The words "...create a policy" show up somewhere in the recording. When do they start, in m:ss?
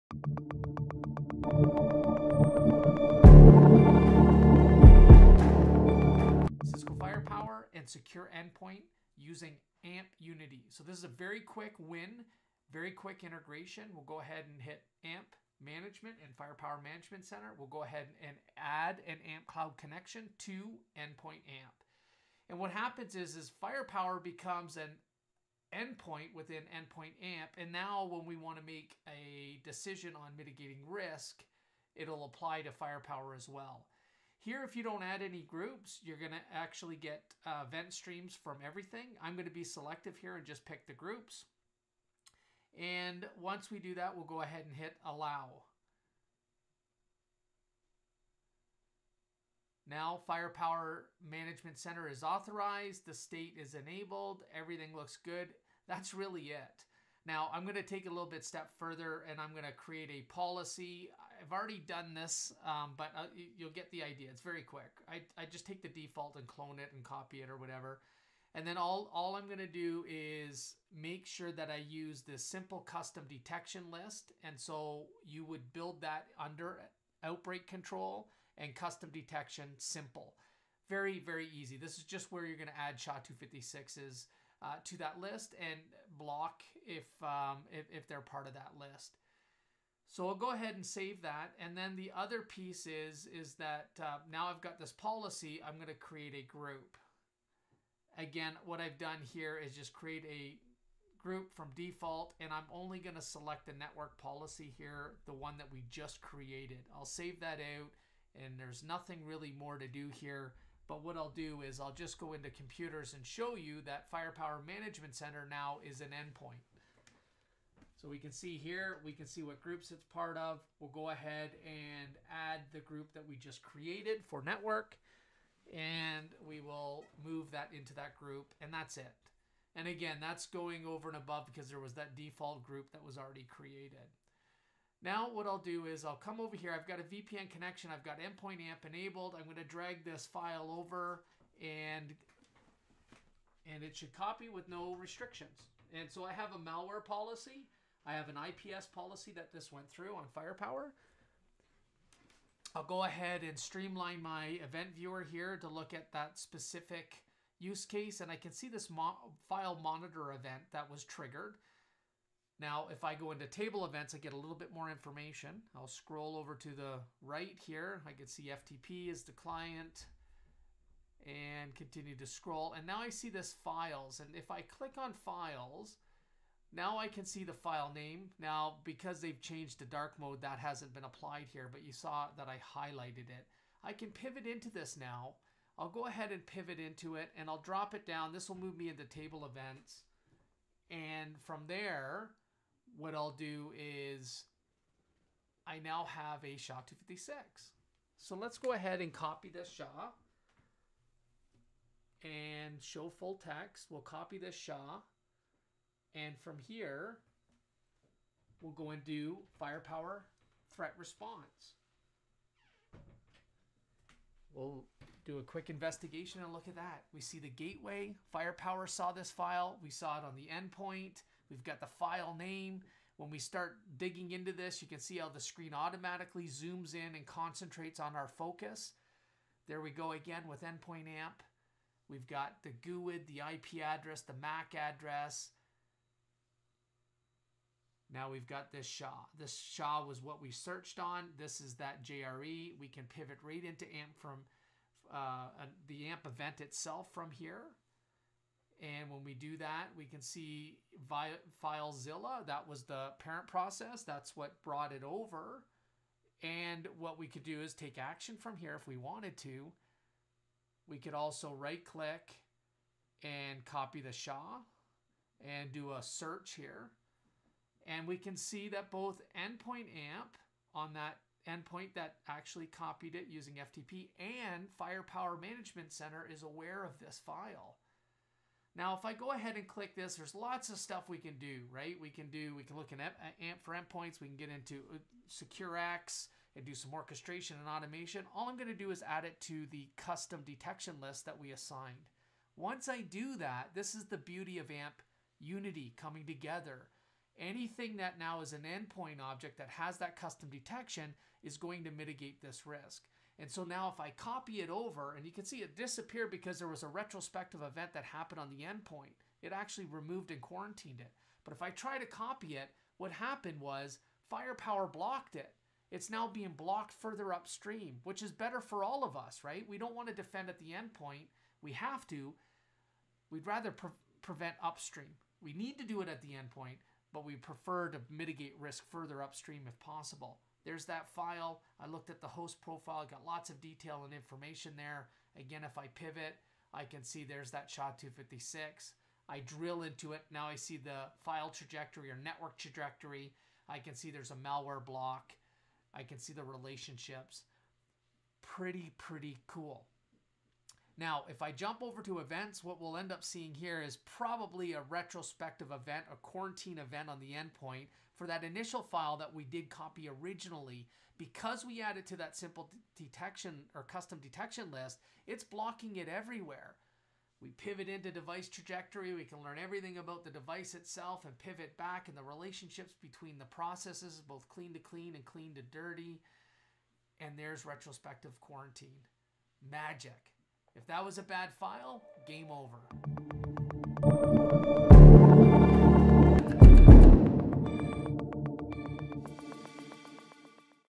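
0:59.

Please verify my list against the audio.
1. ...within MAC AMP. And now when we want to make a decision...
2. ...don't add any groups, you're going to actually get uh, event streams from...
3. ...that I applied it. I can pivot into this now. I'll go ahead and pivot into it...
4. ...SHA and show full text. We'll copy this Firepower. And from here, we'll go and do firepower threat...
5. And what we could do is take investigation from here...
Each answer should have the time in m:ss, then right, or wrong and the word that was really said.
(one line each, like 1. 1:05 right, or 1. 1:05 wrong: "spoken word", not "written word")
1. 0:26 wrong: "Endpoint", not "MAC"
2. 0:34 right
3. 3:02 wrong: "highlighted", not "applied"
4. 3:19 wrong: "SHA", not "Firepower"
5. 4:16 wrong: "action", not "investigation".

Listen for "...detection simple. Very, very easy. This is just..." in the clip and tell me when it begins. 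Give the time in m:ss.
1:19.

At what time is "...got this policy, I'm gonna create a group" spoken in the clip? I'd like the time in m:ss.
1:34.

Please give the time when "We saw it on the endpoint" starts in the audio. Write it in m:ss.
3:39.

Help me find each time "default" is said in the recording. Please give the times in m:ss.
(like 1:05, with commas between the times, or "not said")
1:05, 1:41, 2:12.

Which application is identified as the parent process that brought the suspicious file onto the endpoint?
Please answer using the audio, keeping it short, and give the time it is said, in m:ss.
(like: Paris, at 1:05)
FileZilla, at 4:11.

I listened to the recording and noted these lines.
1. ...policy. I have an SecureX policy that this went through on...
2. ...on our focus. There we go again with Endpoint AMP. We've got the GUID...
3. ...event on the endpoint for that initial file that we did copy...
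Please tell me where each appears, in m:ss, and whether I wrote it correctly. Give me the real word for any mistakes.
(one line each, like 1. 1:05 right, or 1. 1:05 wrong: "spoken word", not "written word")
1. 2:27 wrong: "IPS", not "SecureX"
2. 3:47 right
3. 5:56 right.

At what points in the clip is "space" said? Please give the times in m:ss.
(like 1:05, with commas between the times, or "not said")
not said.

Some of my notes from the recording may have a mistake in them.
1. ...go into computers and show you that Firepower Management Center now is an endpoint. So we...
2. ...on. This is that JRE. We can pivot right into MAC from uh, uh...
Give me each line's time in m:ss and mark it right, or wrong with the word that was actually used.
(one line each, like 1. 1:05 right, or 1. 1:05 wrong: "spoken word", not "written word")
1. 1:52 right
2. 4:00 wrong: "AMP", not "MAC".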